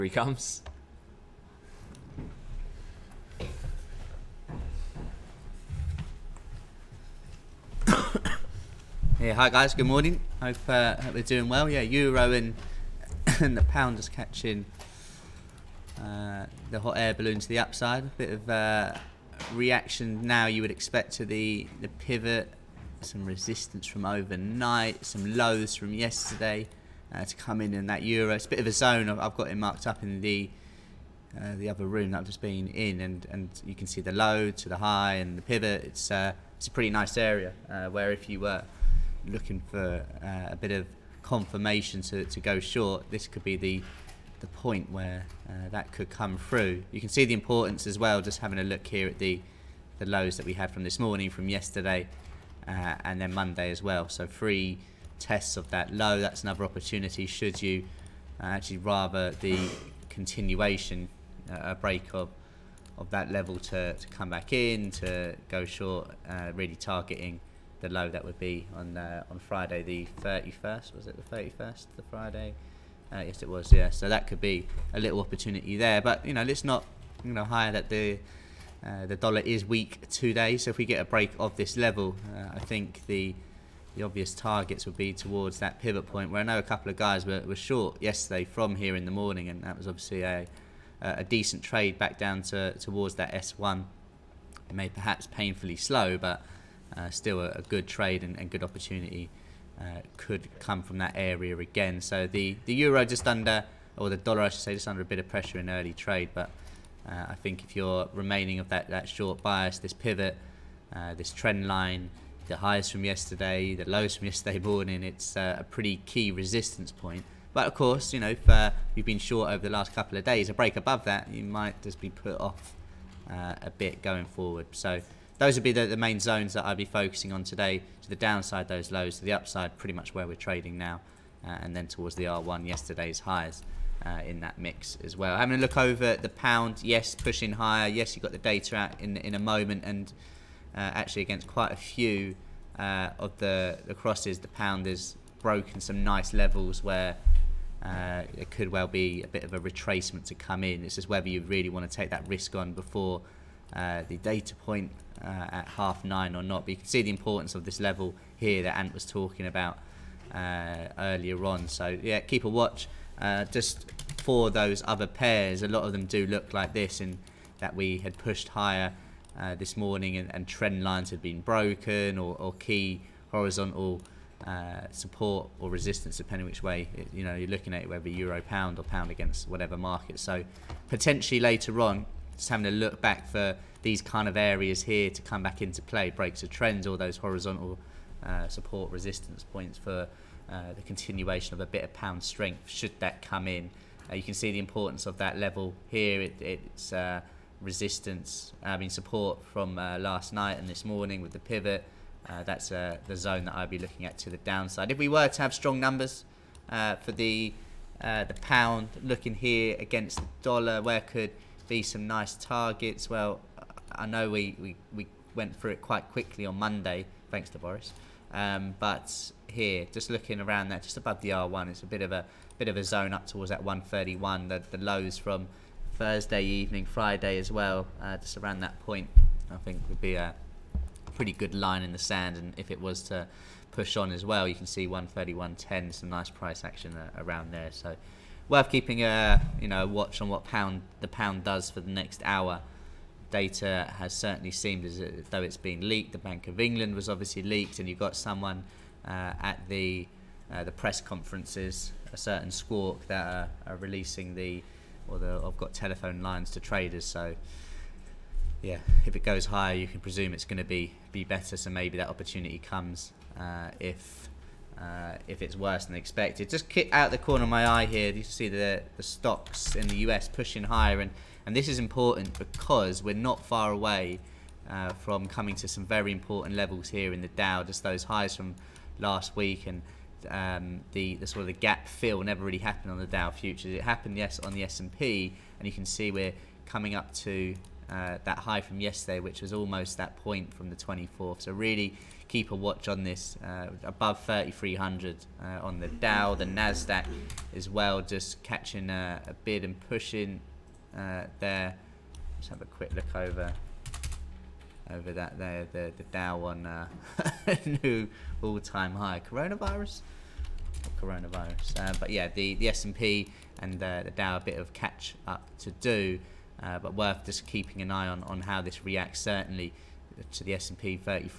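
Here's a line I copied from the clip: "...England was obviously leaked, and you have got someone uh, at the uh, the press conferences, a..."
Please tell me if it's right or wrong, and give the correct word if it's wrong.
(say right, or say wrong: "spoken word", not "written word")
right.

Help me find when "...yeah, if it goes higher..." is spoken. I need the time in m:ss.
4:18.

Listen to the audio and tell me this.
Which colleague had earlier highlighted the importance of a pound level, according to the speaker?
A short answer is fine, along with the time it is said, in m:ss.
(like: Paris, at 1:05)
Ant, at 2:38.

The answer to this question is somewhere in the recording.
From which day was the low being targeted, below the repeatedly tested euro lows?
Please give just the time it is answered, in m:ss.
1:09.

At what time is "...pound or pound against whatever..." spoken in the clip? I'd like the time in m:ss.
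2:58.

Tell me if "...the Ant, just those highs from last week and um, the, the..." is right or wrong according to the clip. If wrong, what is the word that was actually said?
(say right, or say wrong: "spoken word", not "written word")
wrong: "Dow", not "Ant".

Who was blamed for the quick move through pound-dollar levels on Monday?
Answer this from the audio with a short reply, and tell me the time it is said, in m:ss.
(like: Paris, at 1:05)
Boris, at 3:37.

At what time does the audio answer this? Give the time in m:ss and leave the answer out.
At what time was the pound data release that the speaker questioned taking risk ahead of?
2:35.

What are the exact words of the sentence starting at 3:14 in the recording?
Uh, you can see the importance of that level here.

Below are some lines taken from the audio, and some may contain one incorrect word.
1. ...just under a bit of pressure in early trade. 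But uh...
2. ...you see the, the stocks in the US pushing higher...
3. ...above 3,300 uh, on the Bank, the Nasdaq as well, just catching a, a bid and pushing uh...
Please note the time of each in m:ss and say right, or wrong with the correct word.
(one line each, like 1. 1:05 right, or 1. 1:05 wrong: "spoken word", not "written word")
1. 1:44 right
2. 4:28 right
3. 4:53 wrong: "Dow", not "Bank".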